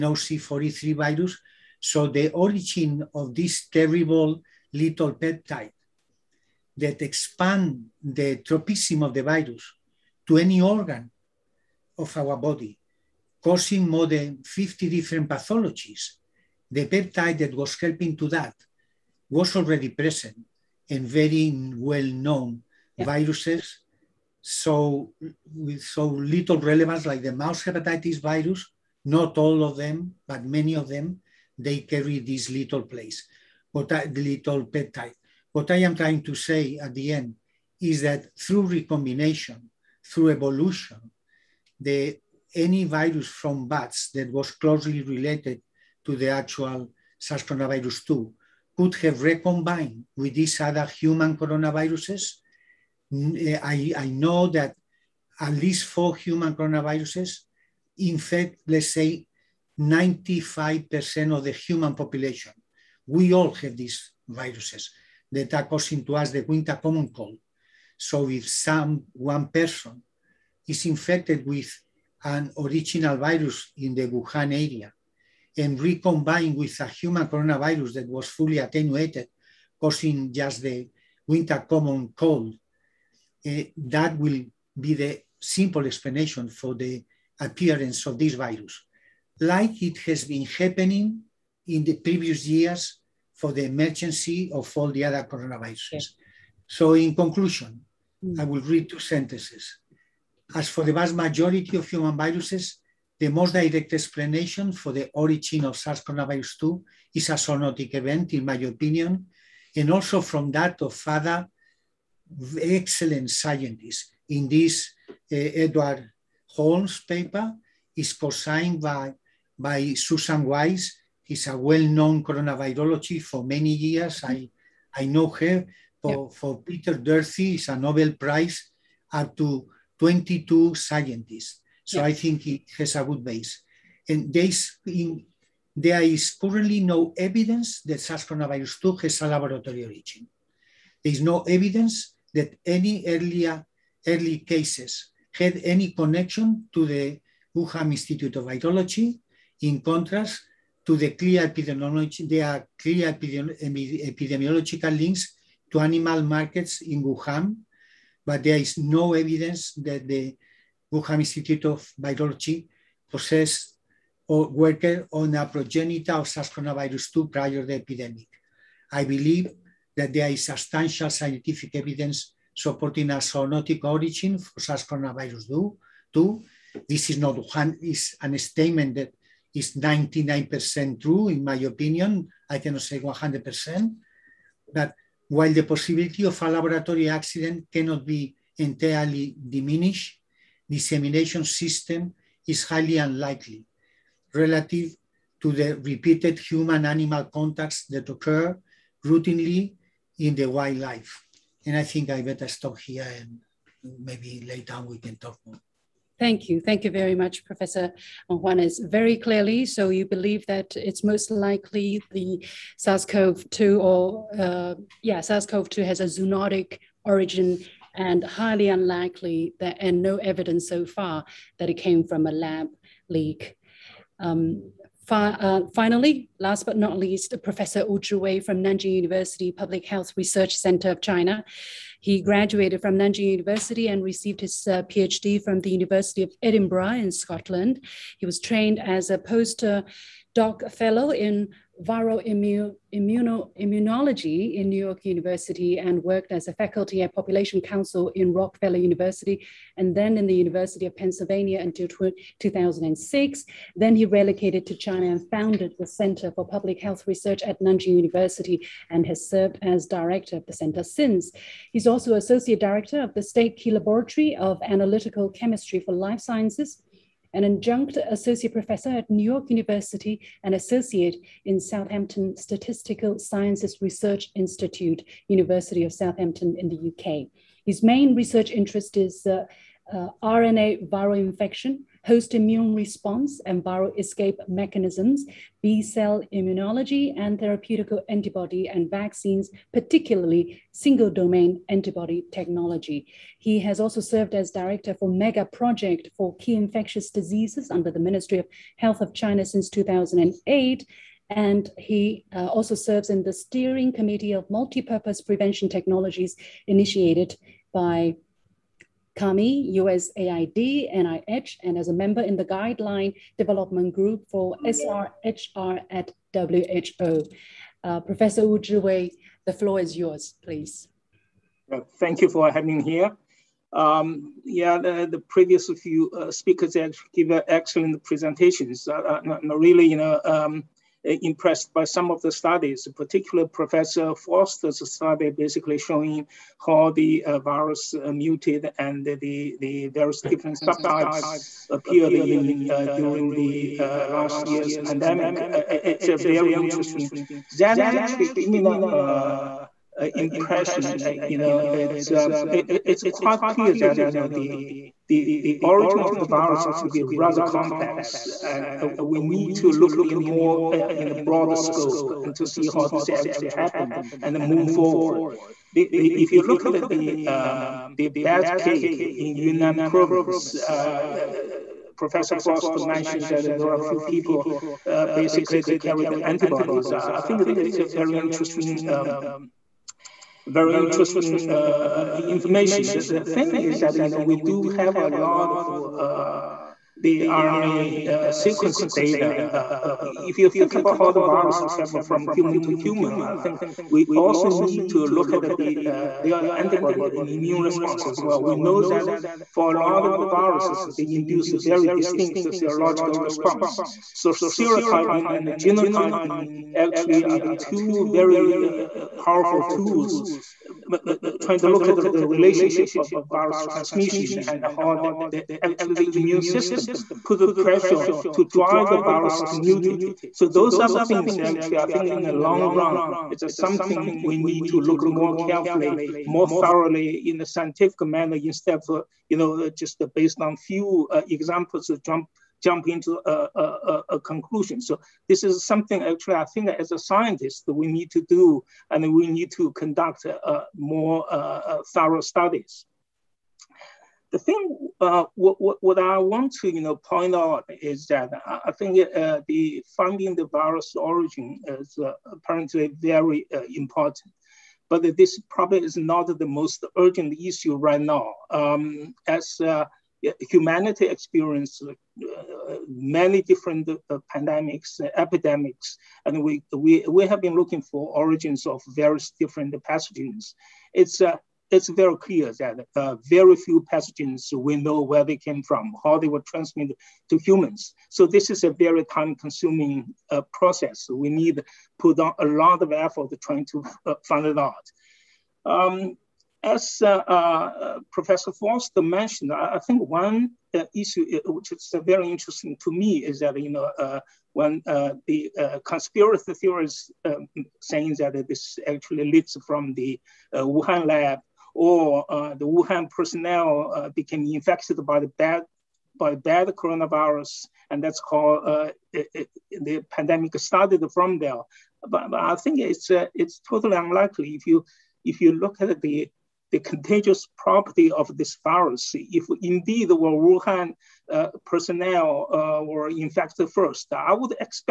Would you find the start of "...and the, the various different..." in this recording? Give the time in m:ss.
5:38.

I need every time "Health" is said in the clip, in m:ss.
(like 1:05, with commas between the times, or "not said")
3:49, 4:16, 4:58.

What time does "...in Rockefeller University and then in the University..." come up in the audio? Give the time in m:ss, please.
4:08.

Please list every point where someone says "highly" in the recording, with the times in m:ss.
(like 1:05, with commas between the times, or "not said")
3:12, 3:38.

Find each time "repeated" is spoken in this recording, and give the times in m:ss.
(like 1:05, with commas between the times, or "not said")
3:15.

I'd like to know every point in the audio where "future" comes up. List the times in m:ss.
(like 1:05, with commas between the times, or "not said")
not said.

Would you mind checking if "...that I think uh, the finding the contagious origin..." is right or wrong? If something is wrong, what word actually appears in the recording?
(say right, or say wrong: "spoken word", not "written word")
wrong: "virus", not "contagious".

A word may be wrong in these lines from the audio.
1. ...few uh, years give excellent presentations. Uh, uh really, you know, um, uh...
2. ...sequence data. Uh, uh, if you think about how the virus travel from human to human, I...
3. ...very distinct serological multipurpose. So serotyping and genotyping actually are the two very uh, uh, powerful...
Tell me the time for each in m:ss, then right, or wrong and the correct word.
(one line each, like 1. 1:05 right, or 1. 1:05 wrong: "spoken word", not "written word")
1. 5:25 wrong: "speakers", not "years"
2. 6:28 right
3. 6:41 wrong: "response", not "multipurpose".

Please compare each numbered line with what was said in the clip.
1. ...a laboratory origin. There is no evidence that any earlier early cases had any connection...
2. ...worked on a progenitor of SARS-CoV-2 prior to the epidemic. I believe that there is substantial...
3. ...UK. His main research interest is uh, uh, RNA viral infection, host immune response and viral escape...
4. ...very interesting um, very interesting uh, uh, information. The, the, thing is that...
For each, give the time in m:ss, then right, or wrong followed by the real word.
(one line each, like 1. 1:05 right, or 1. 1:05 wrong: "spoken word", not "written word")
1. 2:19 right
2. 2:44 right
3. 4:36 right
4. 6:17 right.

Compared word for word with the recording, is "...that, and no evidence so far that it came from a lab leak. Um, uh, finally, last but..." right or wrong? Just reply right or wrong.
right.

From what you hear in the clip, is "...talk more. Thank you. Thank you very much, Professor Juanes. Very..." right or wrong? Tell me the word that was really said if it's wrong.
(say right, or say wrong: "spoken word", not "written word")
right.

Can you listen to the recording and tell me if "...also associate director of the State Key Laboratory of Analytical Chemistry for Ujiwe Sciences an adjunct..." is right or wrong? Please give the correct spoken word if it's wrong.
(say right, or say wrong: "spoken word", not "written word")
wrong: "Life", not "Ujiwe".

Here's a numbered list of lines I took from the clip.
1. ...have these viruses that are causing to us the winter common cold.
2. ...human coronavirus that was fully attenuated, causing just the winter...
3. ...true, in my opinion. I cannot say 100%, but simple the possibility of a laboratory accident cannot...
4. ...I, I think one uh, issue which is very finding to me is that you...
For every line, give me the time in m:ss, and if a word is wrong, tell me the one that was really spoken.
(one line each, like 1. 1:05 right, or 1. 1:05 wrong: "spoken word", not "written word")
1. 1:03 right
2. 1:16 right
3. 3:01 wrong: "while", not "simple"
4. 8:09 wrong: "interesting", not "finding".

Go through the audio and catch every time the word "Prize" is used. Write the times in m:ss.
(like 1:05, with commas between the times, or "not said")
2:08.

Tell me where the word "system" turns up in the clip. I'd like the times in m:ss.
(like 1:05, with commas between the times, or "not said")
3:11, 6:56.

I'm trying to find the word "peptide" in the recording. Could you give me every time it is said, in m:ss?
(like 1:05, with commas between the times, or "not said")
0:05, 0:16, 0:34.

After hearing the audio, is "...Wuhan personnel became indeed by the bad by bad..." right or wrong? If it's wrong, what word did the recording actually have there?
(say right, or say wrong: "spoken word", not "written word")
wrong: "infected", not "indeed".